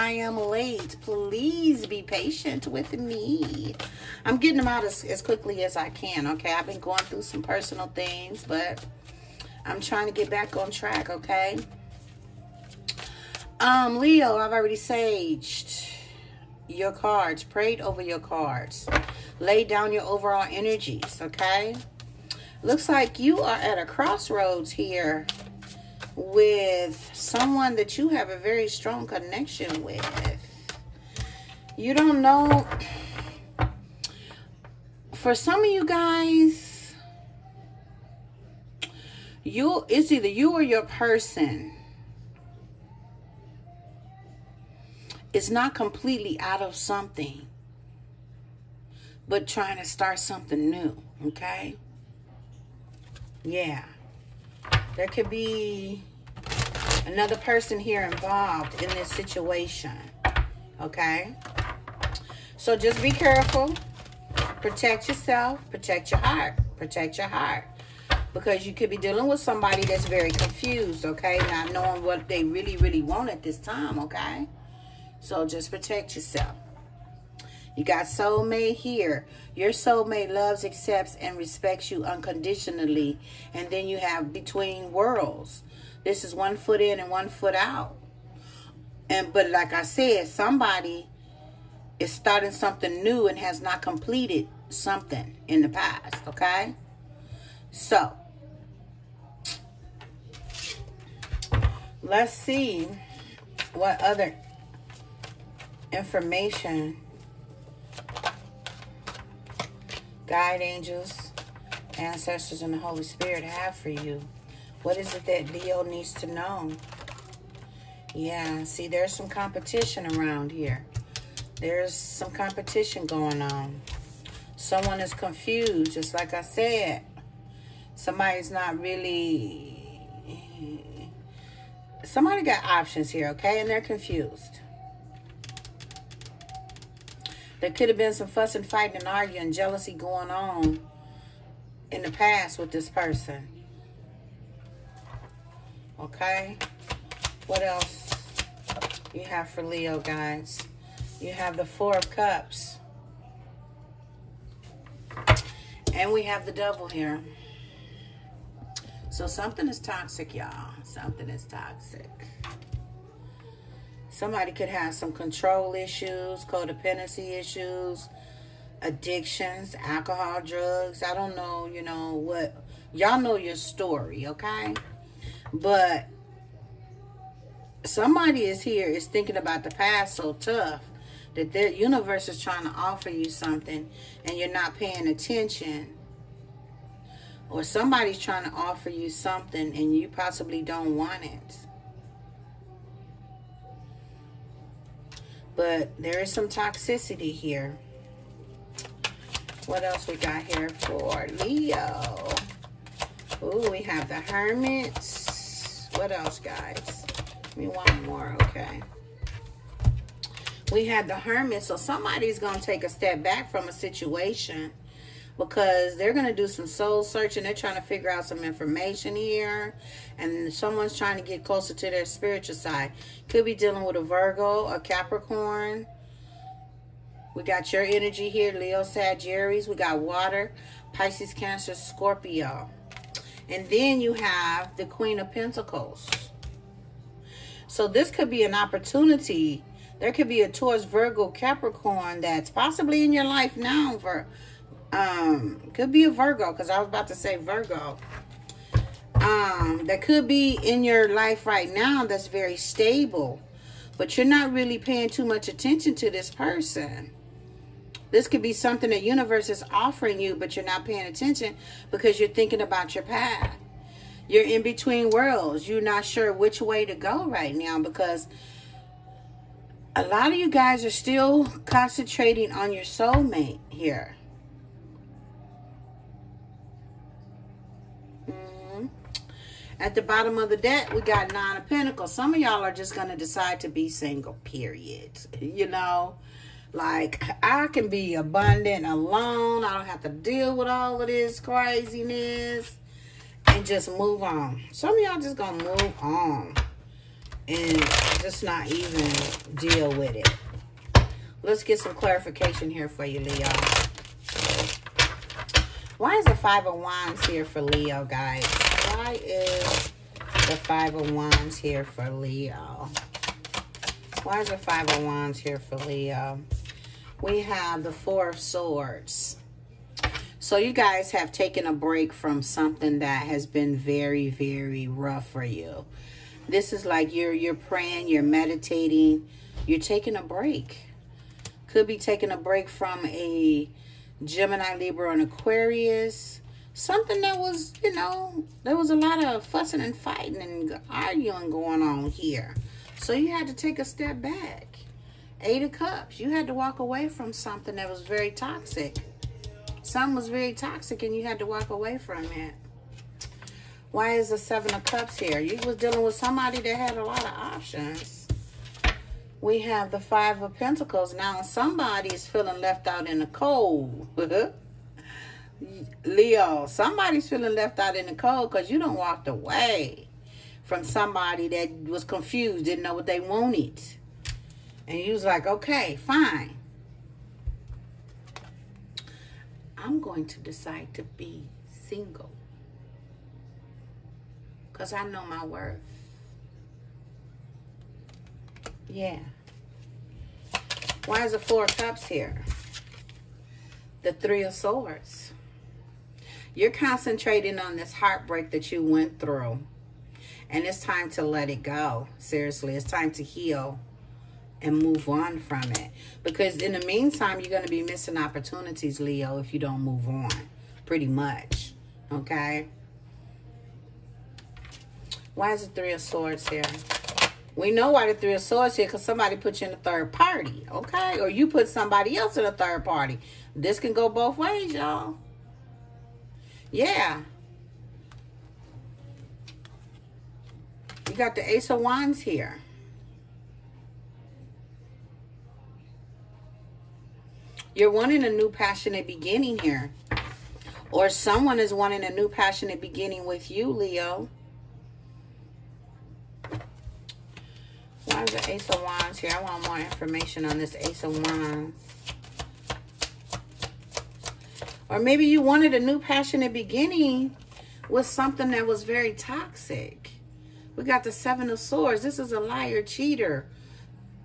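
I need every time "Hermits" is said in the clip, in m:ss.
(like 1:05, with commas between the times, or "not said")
3:24, 3:31.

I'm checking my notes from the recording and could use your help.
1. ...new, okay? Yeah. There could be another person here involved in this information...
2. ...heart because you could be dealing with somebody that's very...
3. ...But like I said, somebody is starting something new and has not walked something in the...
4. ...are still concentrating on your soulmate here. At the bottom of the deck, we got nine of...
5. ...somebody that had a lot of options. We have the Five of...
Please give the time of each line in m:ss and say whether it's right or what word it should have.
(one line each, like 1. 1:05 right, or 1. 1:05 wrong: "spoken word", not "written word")
1. 0:50 wrong: "situation", not "information"
2. 1:07 right
3. 1:29 wrong: "completed", not "walked"
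4. 4:30 right
5. 5:56 right.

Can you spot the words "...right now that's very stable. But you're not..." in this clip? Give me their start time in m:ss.
4:11.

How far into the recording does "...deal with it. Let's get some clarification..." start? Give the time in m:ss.
4:59.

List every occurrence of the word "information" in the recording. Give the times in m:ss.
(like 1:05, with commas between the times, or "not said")
1:45, 3:38, 7:29.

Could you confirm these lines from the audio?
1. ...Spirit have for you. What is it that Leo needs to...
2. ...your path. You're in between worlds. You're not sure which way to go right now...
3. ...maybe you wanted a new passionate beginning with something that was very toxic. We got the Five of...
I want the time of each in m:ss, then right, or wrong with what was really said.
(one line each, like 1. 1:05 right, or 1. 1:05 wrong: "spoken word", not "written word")
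1. 1:53 right
2. 4:22 right
3. 7:34 wrong: "Seven", not "Five".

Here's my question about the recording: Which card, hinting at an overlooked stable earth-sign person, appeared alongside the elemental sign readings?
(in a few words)
Queen of Pentacles.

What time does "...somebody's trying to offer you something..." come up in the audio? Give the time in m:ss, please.
3:07.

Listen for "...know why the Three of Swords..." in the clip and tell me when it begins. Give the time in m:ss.
6:57.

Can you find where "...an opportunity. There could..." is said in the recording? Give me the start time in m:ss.
3:58.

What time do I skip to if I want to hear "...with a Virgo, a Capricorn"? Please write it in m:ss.
3:43.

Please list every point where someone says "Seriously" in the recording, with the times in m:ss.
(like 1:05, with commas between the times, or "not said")
6:42.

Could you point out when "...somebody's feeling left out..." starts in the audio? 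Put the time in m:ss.
6:06.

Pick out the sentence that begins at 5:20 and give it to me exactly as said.
So you guys have taken a break from something that has been very, very rough for you.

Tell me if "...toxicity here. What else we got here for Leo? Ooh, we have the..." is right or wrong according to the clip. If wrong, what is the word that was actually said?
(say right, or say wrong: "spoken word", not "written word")
right.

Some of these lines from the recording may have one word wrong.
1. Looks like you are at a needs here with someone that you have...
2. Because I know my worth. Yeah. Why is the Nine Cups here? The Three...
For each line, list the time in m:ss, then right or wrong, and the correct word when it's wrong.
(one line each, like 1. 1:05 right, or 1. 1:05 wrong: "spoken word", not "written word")
1. 0:22 wrong: "crossroads", not "needs"
2. 6:24 wrong: "Four", not "Nine".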